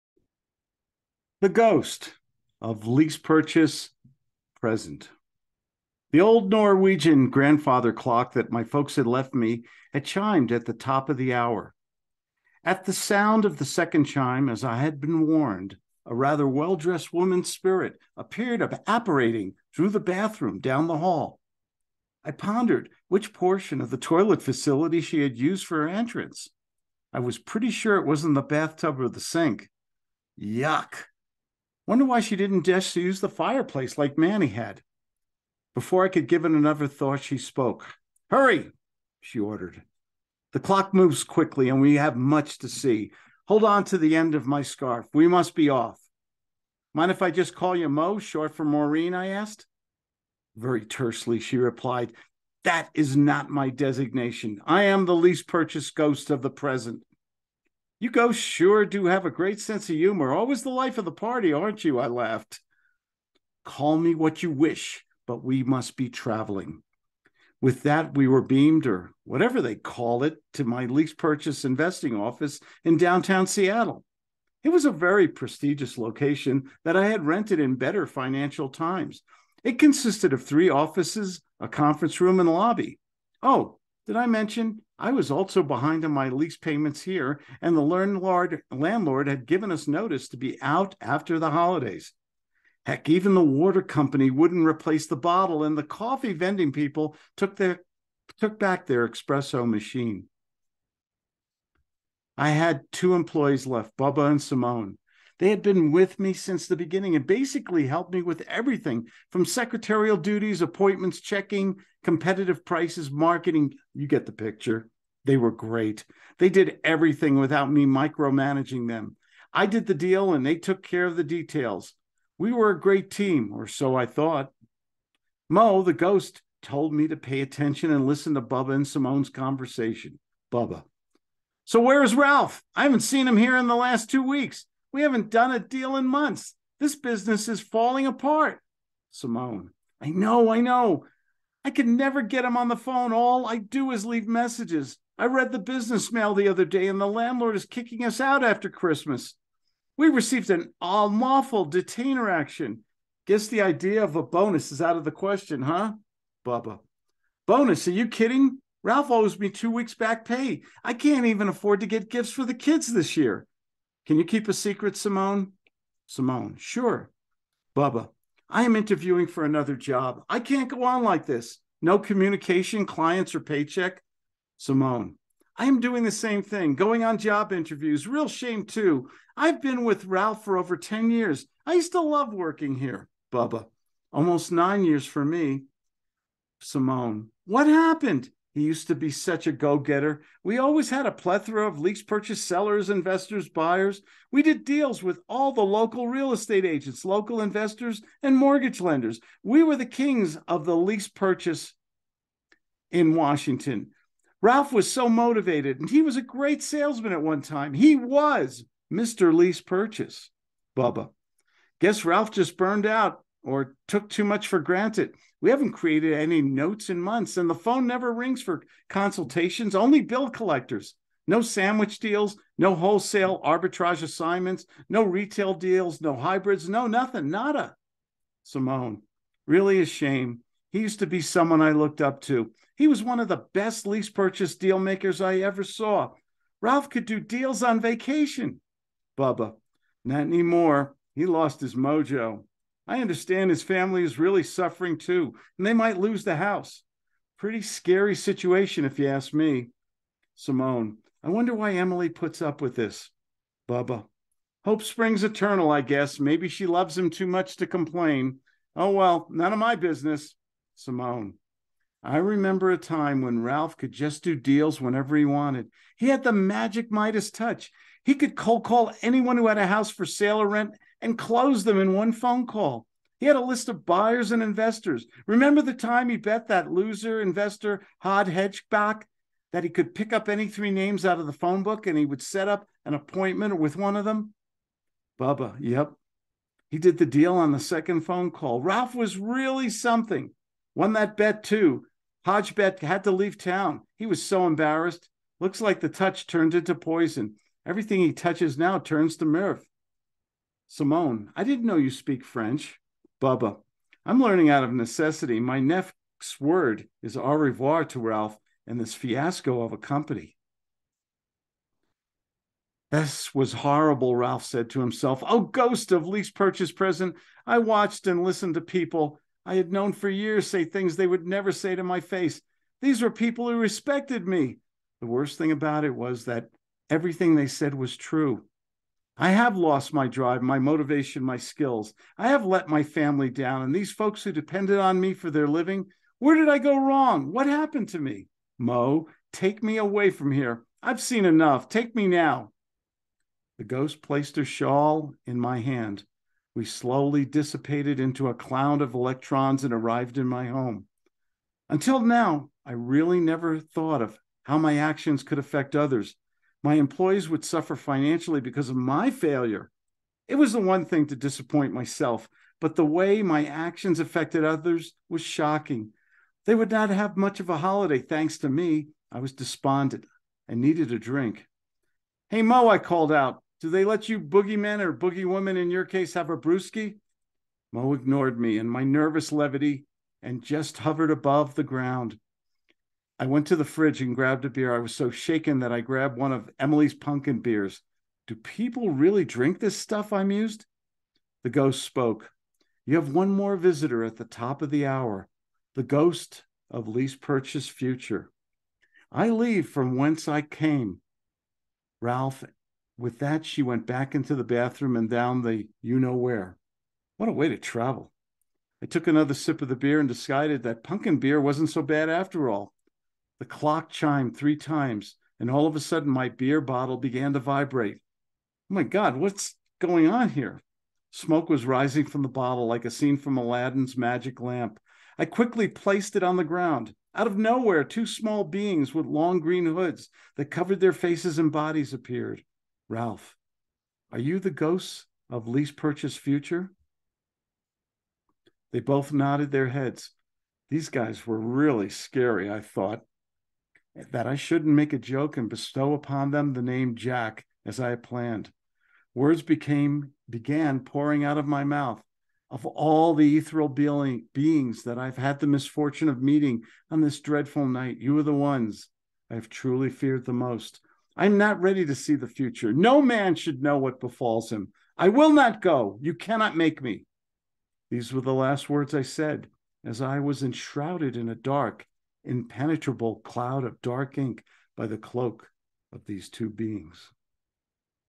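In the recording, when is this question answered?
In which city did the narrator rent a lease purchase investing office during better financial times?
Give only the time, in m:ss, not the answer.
1:12.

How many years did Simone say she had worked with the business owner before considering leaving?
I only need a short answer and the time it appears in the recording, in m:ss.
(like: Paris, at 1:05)
10, at 3:00.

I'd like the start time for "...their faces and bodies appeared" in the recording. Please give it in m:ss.
7:10.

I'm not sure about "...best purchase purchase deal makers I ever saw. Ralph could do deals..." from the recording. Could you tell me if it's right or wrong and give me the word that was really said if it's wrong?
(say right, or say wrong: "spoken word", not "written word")
wrong: "lease", not "purchase".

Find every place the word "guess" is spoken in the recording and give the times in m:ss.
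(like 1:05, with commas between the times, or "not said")
2:33, 3:31, 4:15.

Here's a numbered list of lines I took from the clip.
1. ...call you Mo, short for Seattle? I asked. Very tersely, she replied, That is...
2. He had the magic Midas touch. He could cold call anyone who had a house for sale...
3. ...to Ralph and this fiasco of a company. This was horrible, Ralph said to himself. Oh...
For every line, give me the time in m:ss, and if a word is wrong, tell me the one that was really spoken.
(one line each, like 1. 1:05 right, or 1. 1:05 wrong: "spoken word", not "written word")
1. 0:47 wrong: "Maureen", not "Seattle"
2. 4:25 right
3. 5:07 right.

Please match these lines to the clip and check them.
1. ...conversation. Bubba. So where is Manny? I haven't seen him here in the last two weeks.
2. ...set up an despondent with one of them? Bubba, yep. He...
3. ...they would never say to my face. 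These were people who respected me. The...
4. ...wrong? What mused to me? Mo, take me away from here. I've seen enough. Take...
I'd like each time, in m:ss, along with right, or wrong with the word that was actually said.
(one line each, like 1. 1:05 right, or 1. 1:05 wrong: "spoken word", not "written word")
1. 2:09 wrong: "Ralph", not "Manny"
2. 4:42 wrong: "appointment", not "despondent"
3. 5:20 right
4. 5:36 wrong: "happened", not "mused".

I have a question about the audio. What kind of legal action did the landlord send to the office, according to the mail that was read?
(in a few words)
Unlawful detainer action.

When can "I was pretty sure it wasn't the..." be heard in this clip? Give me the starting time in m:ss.
0:27.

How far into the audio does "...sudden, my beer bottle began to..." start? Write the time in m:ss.
6:55.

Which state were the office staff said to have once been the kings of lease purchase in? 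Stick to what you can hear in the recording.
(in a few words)
Washington.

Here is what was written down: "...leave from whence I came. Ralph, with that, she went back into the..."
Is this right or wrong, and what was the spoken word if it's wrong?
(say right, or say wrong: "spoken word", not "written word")
right.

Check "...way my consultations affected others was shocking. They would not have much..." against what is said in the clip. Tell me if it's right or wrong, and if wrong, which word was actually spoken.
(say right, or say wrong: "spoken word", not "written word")
wrong: "actions", not "consultations".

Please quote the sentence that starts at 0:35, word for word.
Before I could give it another thought, she spoke.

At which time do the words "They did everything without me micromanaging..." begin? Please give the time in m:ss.
1:56.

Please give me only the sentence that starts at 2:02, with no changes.
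We were a great team, or so I thought.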